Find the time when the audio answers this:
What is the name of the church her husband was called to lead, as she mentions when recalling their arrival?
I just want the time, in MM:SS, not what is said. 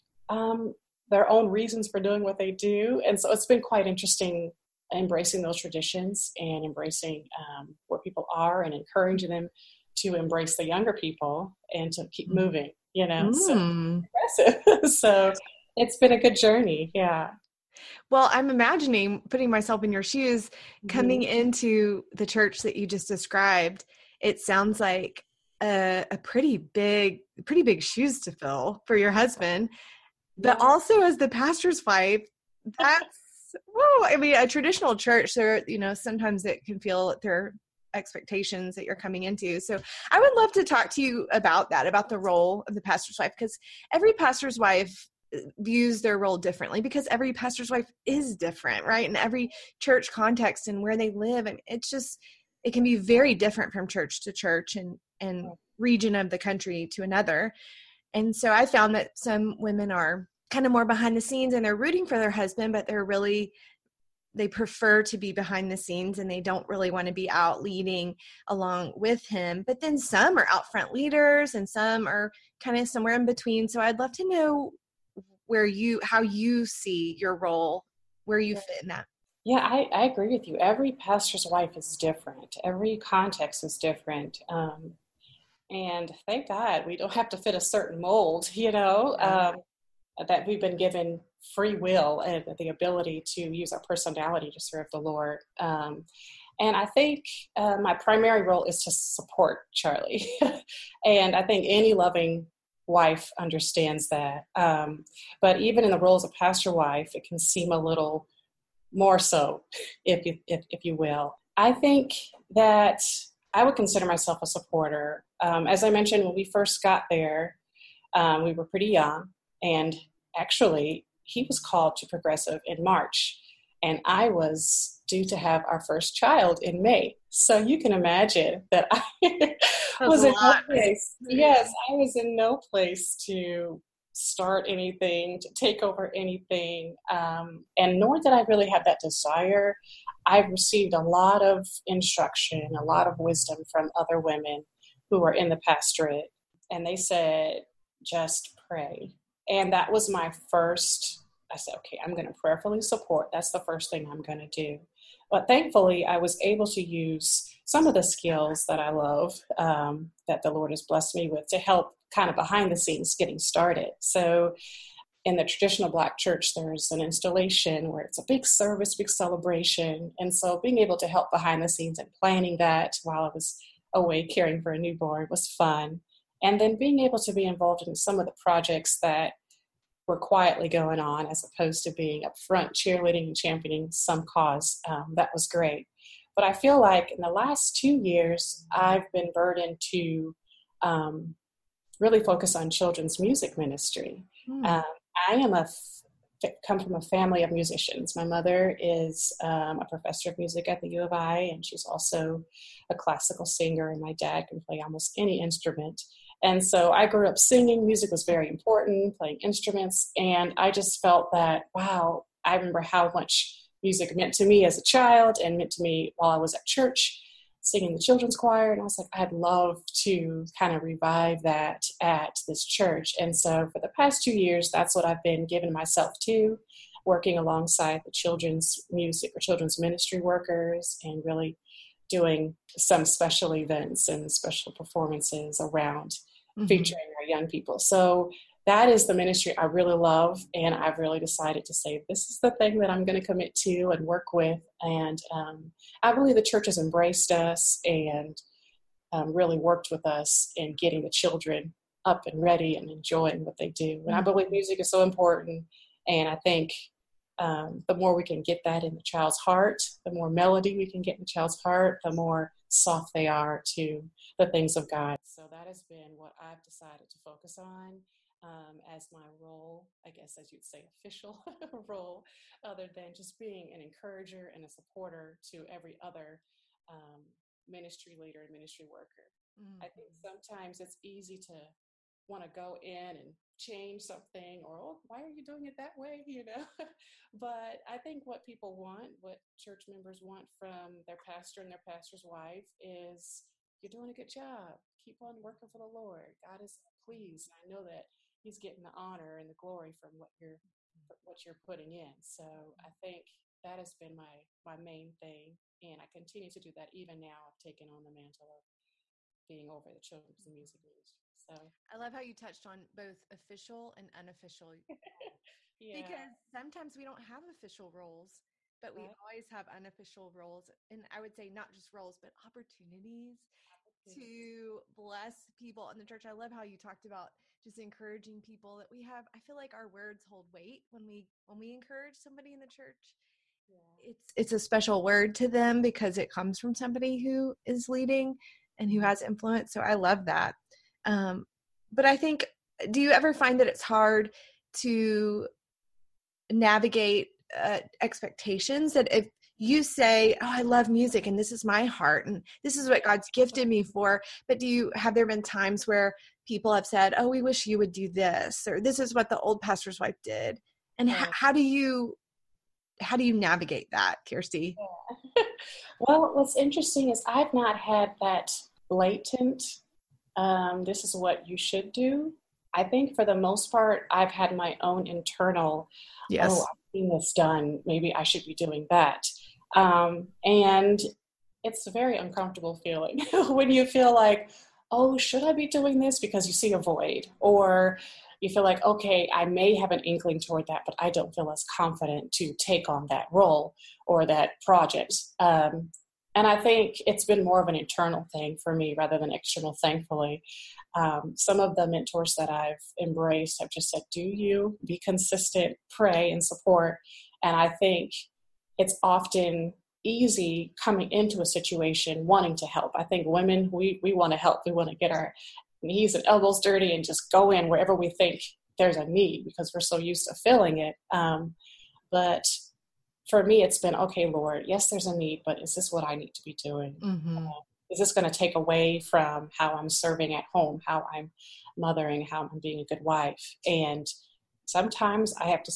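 02:02.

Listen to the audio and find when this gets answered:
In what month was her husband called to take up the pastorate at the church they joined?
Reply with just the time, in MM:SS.
02:02.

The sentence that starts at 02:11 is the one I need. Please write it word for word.
Yes, I was in no place to start anything, to take over anything, um, and nor did I really have that desire.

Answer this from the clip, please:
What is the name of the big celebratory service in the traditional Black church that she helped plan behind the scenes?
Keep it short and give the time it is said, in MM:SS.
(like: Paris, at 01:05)
Installation, at 02:46.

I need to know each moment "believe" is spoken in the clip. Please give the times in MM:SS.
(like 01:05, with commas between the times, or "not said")
04:06, 04:14.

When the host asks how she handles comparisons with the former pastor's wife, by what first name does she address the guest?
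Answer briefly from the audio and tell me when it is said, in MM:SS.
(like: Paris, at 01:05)
Kirstie, at 06:04.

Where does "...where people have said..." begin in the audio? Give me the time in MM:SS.
05:55.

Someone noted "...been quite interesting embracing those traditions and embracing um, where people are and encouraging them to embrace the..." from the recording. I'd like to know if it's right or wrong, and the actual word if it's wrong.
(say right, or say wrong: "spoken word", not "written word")
right.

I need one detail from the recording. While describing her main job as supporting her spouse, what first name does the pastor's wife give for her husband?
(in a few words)
Charlie.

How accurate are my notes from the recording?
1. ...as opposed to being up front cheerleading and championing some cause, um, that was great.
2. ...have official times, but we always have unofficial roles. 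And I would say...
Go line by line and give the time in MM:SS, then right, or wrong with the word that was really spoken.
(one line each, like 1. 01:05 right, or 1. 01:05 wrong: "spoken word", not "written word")
1. 03:01 right
2. 05:17 wrong: "roles", not "times".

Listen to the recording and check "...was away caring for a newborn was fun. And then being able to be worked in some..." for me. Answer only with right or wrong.
wrong.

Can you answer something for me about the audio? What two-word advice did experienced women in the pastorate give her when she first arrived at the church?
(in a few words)
Just pray.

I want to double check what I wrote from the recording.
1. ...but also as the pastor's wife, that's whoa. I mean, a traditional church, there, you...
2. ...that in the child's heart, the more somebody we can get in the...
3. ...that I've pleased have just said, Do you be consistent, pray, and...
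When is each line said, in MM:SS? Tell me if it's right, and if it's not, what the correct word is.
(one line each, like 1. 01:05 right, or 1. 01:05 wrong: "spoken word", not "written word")
1. 00:30 right
2. 04:18 wrong: "melody", not "somebody"
3. 06:42 wrong: "embraced", not "pleased".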